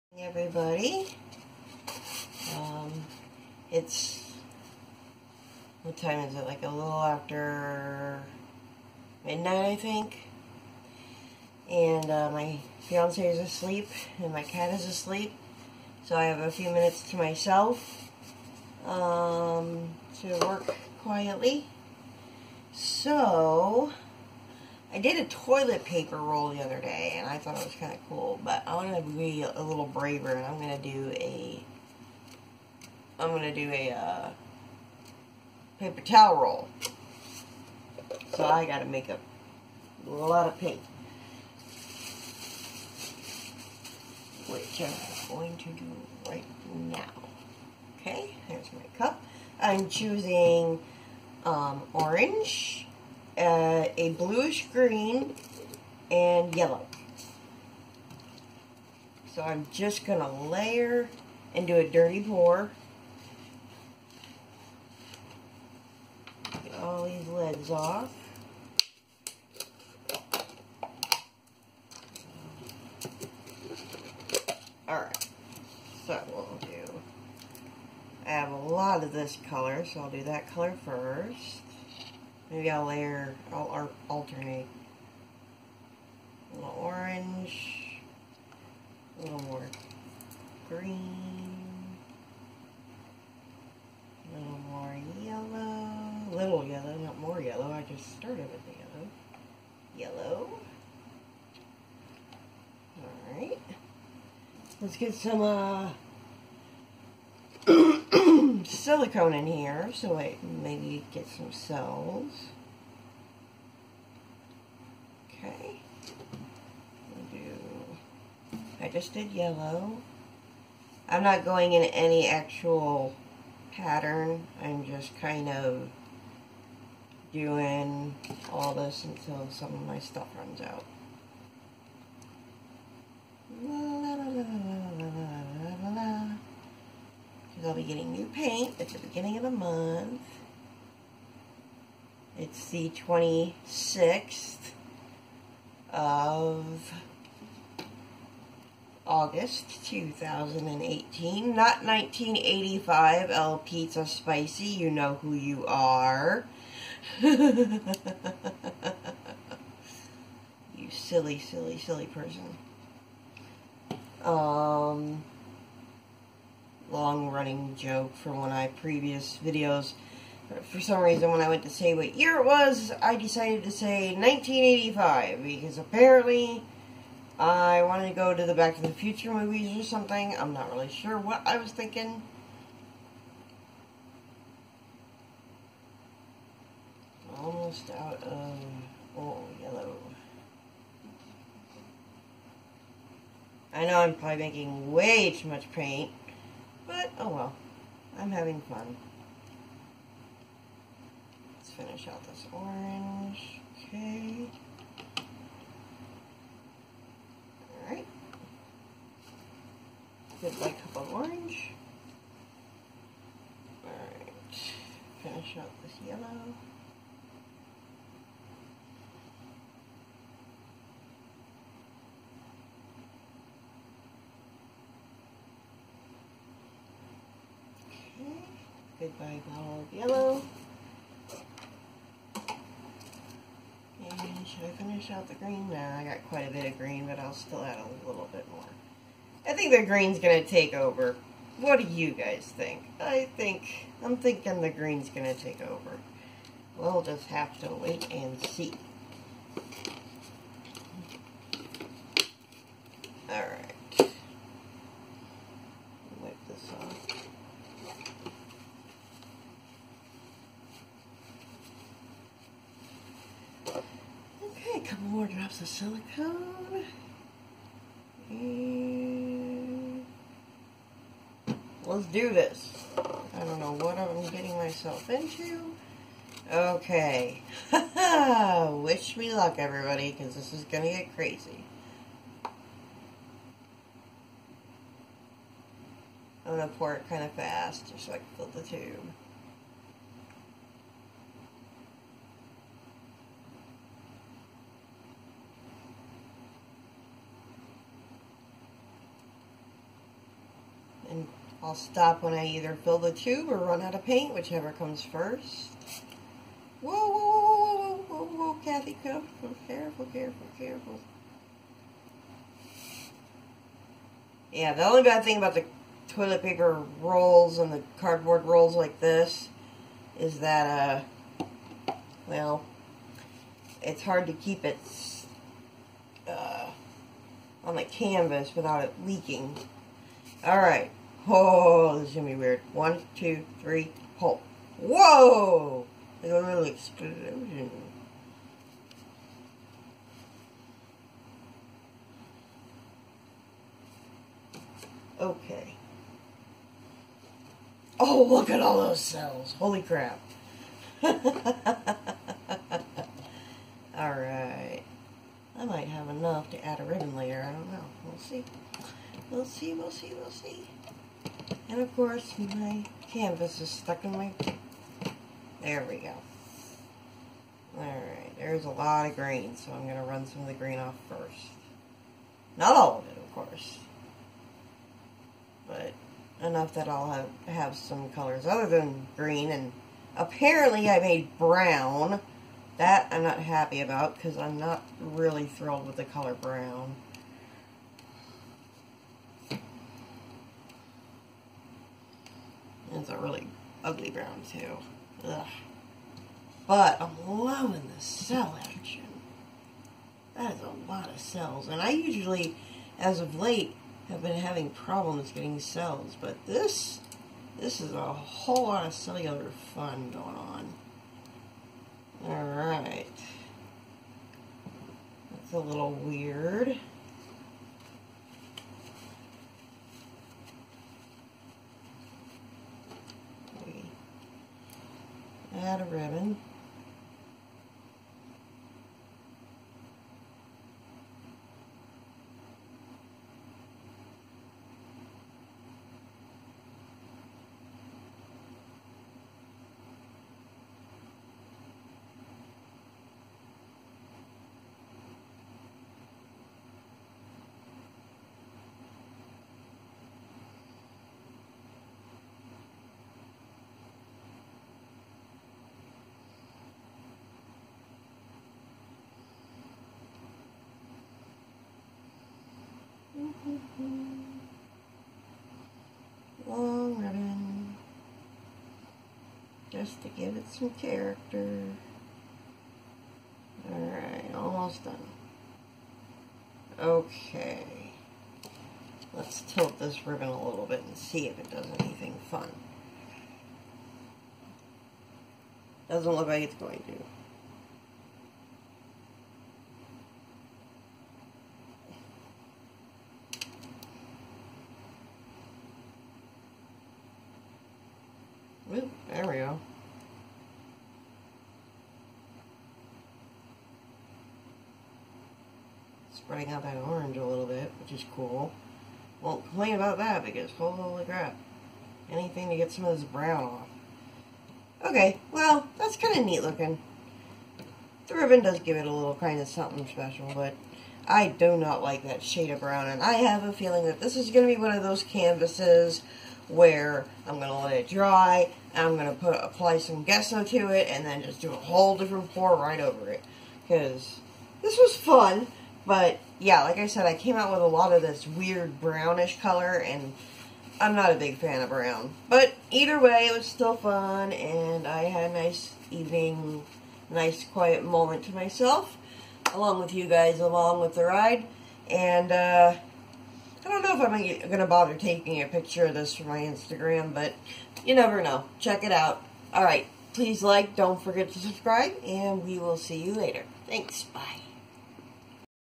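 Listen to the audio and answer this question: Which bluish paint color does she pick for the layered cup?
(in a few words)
bluish green.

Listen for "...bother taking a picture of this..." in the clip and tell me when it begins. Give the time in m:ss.
9:14.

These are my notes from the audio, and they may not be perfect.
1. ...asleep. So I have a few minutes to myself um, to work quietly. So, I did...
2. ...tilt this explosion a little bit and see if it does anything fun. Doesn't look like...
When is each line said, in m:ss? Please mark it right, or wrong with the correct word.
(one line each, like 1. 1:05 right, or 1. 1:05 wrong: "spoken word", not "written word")
1. 0:14 right
2. 7:59 wrong: "ribbon", not "explosion".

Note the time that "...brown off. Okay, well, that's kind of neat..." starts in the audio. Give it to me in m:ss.
8:33.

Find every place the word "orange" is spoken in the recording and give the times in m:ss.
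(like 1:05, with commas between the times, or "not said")
0:51, 1:26, 3:22, 3:31, 8:26.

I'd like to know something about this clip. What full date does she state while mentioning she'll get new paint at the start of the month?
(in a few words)
26 August 2018.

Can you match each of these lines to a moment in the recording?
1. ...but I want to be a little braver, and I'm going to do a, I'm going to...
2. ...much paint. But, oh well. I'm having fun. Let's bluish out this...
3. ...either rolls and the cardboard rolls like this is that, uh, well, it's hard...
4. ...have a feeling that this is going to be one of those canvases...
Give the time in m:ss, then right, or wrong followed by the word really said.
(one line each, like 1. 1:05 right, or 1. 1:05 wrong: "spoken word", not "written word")
1. 0:28 right
2. 3:15 wrong: "finish", not "bluish"
3. 5:16 wrong: "paper", not "either"
4. 8:43 right.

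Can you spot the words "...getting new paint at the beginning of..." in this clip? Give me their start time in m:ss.
2:17.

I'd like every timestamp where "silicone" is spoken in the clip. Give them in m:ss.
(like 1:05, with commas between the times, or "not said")
1:48, 4:25.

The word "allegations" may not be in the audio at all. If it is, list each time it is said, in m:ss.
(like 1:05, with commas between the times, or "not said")
not said.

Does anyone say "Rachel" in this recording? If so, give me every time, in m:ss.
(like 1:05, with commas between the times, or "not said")
not said.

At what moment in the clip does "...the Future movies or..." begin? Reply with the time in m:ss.
2:58.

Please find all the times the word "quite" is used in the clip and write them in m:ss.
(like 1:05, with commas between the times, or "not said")
3:56.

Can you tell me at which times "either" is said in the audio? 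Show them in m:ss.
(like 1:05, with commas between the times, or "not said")
5:02, 9:02.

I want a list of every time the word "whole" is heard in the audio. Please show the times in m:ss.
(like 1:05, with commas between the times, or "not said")
6:48, 8:51.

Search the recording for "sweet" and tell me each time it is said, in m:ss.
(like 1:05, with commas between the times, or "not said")
not said.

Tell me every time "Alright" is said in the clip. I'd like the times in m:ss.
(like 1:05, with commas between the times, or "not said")
1:14, 1:43, 3:27, 3:33, 5:51, 6:07, 6:52, 7:53.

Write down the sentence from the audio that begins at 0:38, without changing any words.
So I got to make a lot of paint, Which I'm going to do right now.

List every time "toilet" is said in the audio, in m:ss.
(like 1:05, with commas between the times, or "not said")
0:25, 5:16.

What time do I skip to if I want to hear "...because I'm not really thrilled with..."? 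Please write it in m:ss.
6:24.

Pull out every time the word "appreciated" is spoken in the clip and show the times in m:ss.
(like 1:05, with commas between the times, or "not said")
not said.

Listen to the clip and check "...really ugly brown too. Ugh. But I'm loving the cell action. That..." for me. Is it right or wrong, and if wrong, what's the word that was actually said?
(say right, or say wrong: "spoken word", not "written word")
right.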